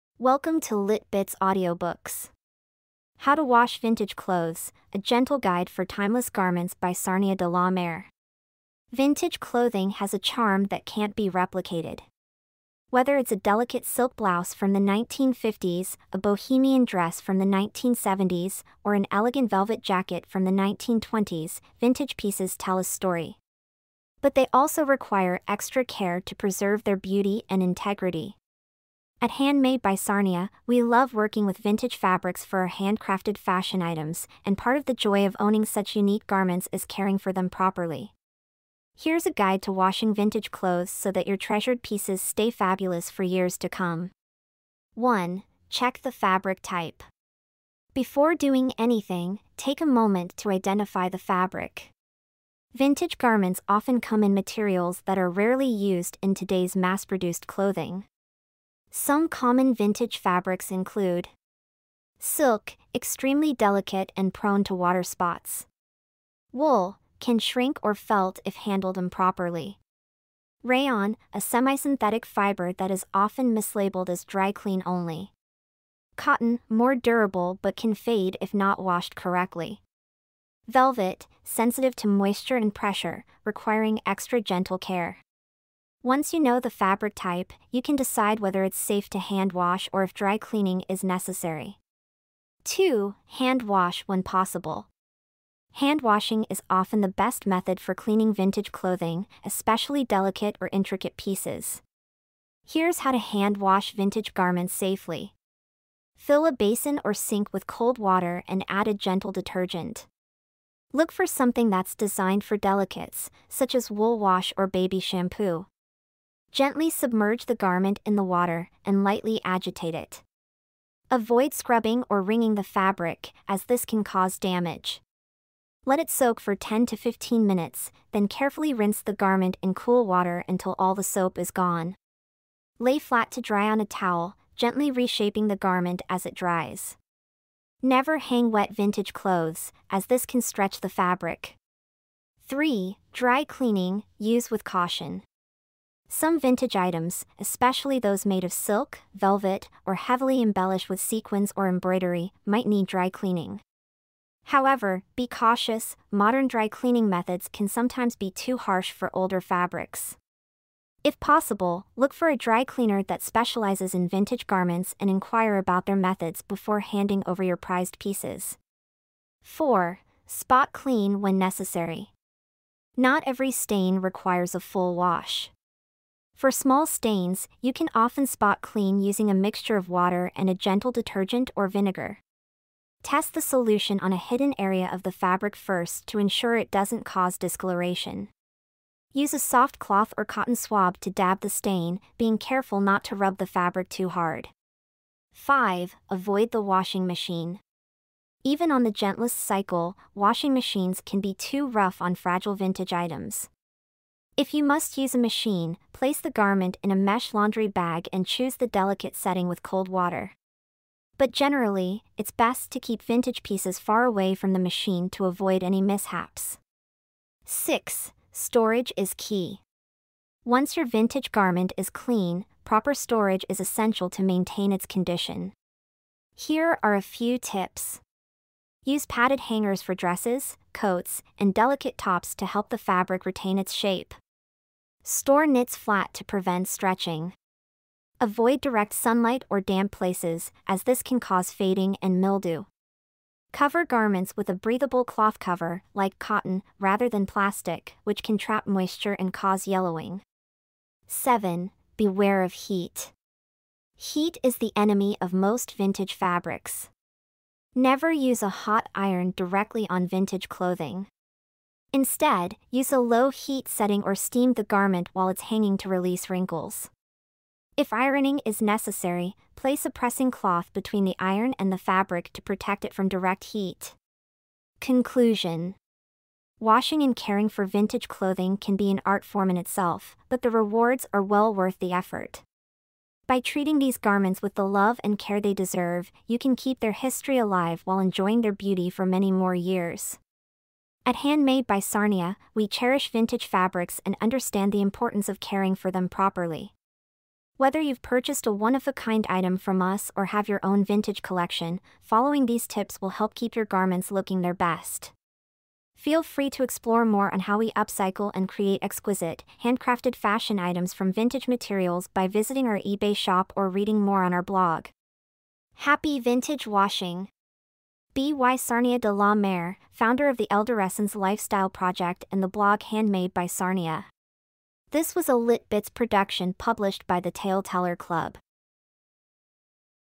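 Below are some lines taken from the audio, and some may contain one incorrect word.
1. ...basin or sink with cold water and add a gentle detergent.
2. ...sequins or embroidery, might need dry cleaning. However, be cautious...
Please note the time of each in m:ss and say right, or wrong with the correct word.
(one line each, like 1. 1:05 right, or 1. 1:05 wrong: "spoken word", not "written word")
1. 1:46 right
2. 2:30 right.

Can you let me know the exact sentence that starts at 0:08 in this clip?
Vintage clothing has a charm that can't be replicated.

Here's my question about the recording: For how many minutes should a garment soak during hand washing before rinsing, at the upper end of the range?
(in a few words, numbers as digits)
15.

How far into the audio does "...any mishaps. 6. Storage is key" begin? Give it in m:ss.
3:35.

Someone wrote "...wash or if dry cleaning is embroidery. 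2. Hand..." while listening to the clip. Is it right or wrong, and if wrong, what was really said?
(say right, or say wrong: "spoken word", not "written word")
wrong: "necessary", not "embroidery".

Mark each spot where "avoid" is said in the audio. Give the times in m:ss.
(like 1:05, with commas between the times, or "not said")
2:01, 3:16, 3:35, 3:58.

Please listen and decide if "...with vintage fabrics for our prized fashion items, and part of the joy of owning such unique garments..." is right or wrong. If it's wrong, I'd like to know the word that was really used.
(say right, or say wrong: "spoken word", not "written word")
wrong: "handcrafted", not "prized".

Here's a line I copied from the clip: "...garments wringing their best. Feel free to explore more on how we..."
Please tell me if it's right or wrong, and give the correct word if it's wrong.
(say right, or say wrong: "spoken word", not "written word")
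wrong: "looking", not "wringing".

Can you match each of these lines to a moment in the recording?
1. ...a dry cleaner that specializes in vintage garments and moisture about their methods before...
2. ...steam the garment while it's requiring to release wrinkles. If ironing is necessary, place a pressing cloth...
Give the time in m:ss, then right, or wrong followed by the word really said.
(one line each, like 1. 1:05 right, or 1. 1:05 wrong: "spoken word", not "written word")
1. 2:42 wrong: "inquire", not "moisture"
2. 4:24 wrong: "hanging", not "requiring".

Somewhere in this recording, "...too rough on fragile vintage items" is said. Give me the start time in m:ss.
3:21.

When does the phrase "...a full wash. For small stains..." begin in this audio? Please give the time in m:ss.
2:54.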